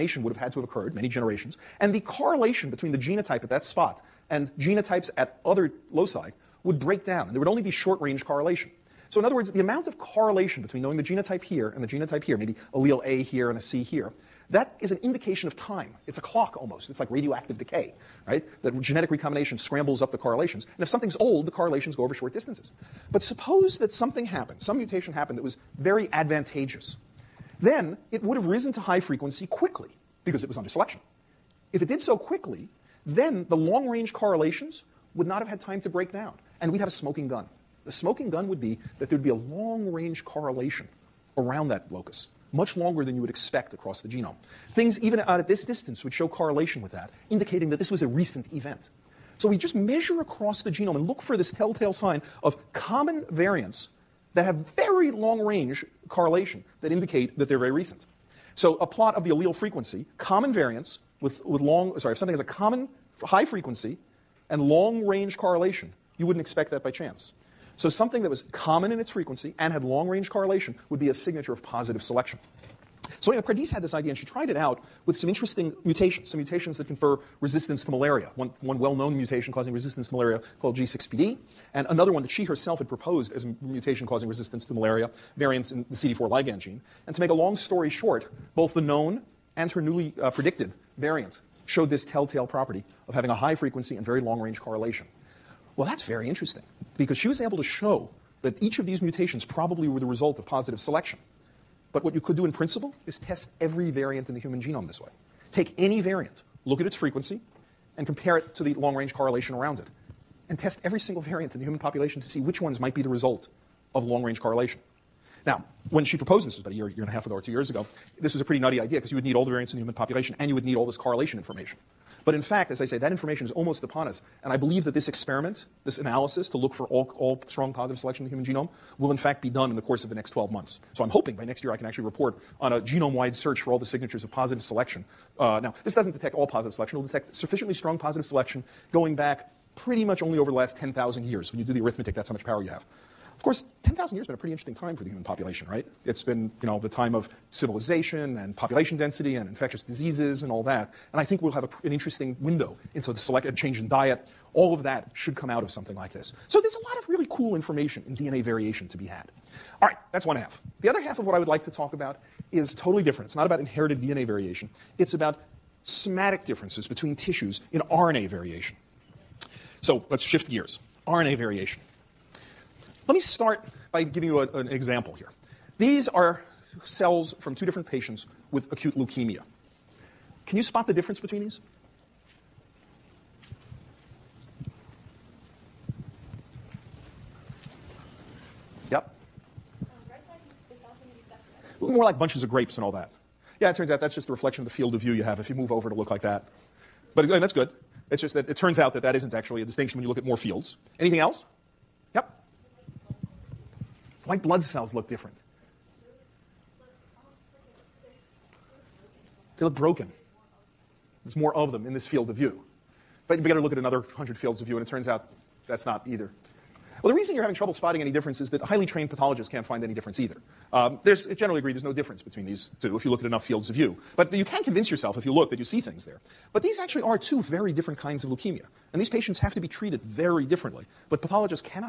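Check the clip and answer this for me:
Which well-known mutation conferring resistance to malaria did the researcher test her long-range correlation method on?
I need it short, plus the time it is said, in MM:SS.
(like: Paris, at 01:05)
G6PD, at 01:20.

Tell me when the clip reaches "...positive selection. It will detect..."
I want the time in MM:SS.
02:16.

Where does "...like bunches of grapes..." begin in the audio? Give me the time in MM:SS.
03:12.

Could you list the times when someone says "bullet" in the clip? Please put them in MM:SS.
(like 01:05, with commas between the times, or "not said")
not said.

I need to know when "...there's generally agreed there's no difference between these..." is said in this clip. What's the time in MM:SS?
03:41.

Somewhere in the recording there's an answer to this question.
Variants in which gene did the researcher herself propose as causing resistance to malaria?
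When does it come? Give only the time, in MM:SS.
01:25.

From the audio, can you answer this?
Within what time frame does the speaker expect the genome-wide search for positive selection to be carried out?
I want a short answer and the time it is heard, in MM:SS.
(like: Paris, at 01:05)
12 months, at 02:10.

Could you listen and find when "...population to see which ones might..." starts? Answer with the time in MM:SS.
01:51.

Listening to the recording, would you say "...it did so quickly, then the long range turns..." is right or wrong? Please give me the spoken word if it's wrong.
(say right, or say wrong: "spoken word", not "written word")
wrong: "correlations", not "turns".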